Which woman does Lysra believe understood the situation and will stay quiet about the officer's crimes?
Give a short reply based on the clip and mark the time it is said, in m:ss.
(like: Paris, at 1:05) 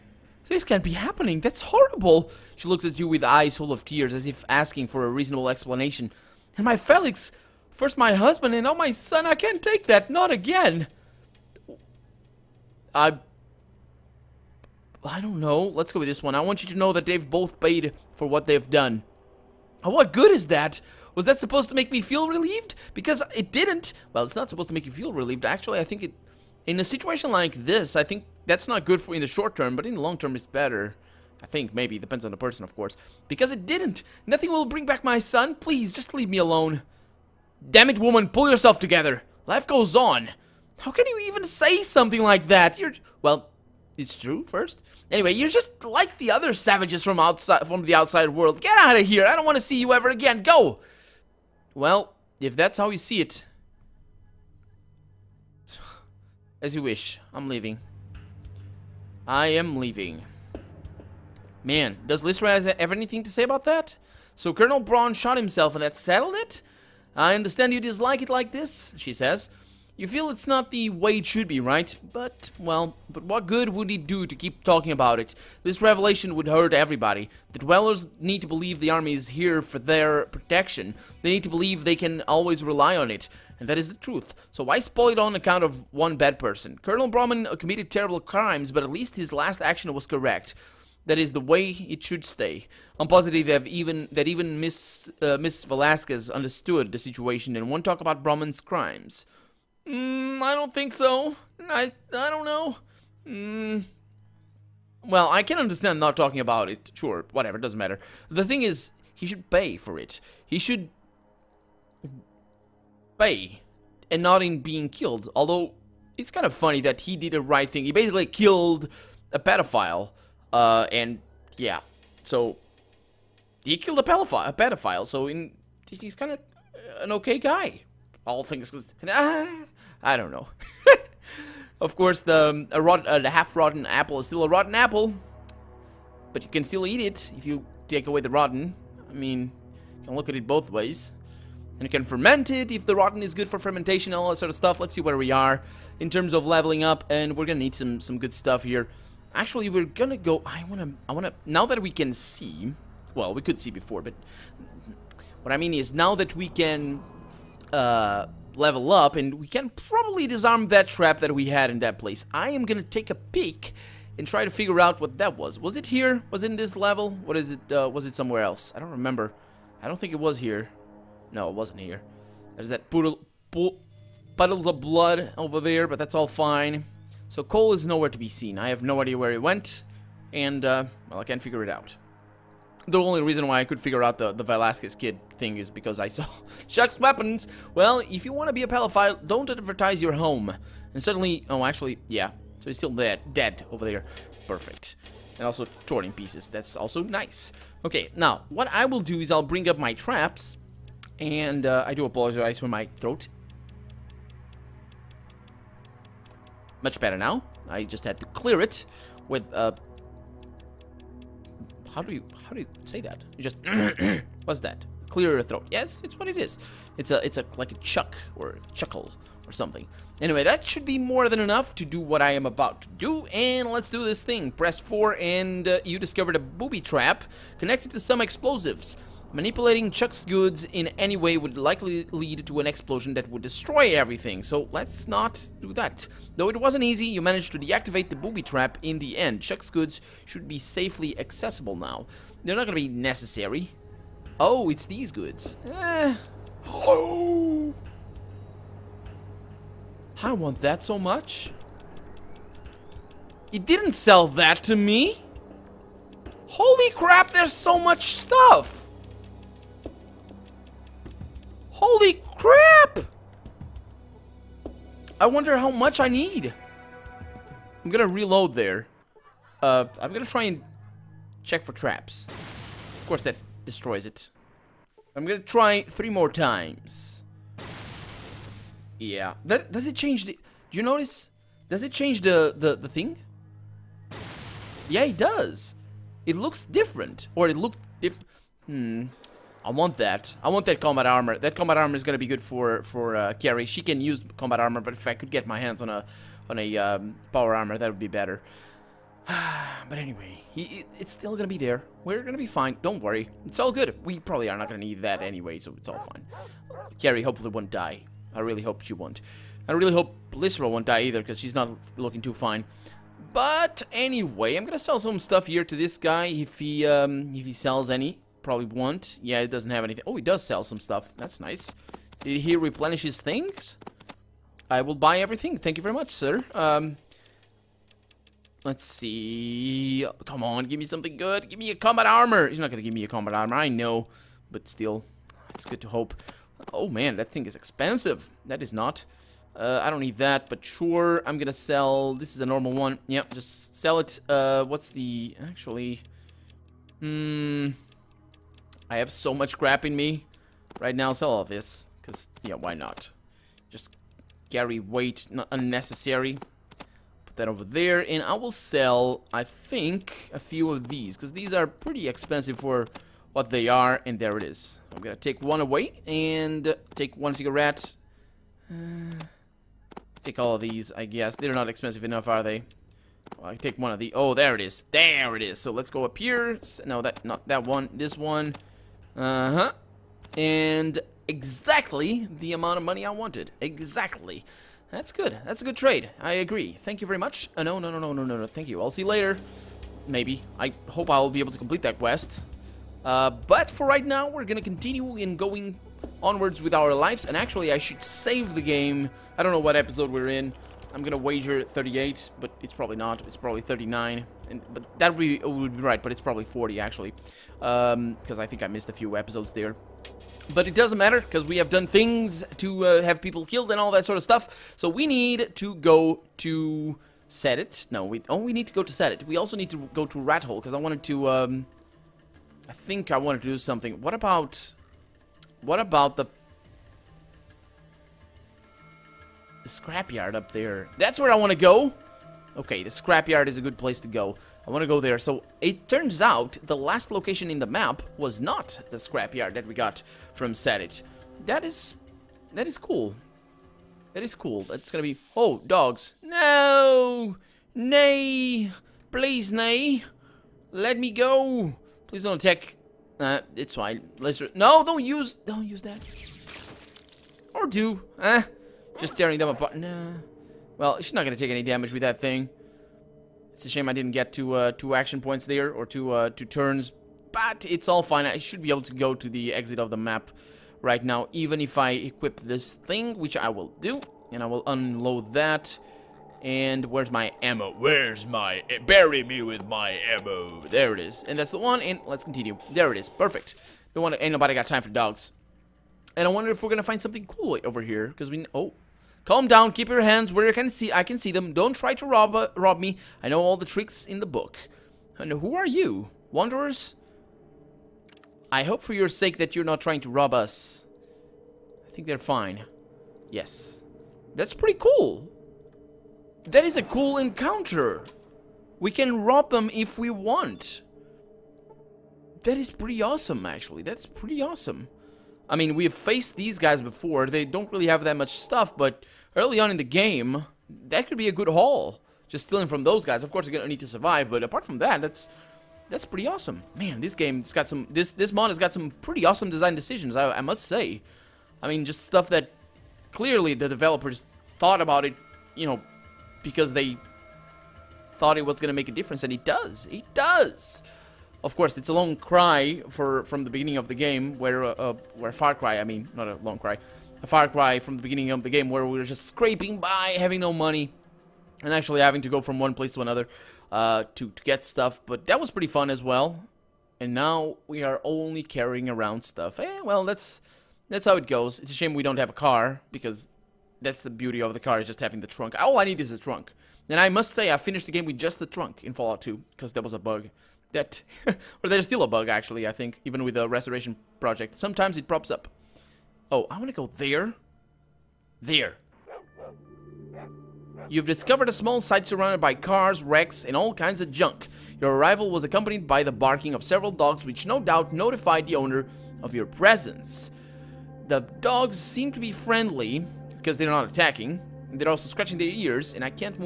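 Miss Velasquez, at 1:35.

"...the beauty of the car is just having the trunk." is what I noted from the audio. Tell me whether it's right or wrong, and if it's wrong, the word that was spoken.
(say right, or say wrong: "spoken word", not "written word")
right.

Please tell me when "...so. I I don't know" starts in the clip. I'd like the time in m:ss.
1:40.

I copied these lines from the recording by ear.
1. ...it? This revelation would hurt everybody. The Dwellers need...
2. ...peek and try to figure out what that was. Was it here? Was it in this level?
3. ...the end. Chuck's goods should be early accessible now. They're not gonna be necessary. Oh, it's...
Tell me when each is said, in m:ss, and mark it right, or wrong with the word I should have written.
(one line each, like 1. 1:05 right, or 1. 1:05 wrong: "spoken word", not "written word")
1. 1:15 right
2. 2:43 right
3. 3:58 wrong: "safely", not "early".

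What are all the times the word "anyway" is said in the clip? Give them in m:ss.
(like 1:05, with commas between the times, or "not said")
0:45, 3:40, 4:59, 5:05, 5:13.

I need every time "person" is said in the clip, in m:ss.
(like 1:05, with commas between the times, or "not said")
0:32, 1:26.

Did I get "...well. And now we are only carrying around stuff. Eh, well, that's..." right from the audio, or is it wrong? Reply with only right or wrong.
right.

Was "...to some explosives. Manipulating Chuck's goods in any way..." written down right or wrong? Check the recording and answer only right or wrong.
right.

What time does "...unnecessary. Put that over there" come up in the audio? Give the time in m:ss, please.
5:55.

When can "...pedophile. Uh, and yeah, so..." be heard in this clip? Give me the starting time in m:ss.
1:59.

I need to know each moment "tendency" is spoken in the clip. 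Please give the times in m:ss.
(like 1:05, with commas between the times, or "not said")
not said.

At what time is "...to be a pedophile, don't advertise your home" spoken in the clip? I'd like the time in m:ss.
3:08.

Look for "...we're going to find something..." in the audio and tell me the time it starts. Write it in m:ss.
8:06.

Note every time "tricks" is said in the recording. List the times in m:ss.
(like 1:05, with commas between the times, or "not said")
8:13.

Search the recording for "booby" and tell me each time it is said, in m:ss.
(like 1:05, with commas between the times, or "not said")
3:46, 3:58.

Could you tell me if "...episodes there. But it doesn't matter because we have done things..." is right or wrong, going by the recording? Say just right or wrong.
right.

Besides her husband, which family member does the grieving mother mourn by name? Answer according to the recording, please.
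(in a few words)
Felix.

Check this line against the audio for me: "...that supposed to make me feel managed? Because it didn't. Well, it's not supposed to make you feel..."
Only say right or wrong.
wrong.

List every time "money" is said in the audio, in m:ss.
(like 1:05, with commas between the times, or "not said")
6:22, 9:10.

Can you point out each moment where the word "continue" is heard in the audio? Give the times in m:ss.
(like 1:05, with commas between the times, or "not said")
6:34, 8:02.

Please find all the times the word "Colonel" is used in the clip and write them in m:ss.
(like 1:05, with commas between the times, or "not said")
1:04, 1:26.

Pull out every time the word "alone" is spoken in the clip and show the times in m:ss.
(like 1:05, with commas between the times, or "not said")
0:36.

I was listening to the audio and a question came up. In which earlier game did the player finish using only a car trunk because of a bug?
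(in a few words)
Fallout 2.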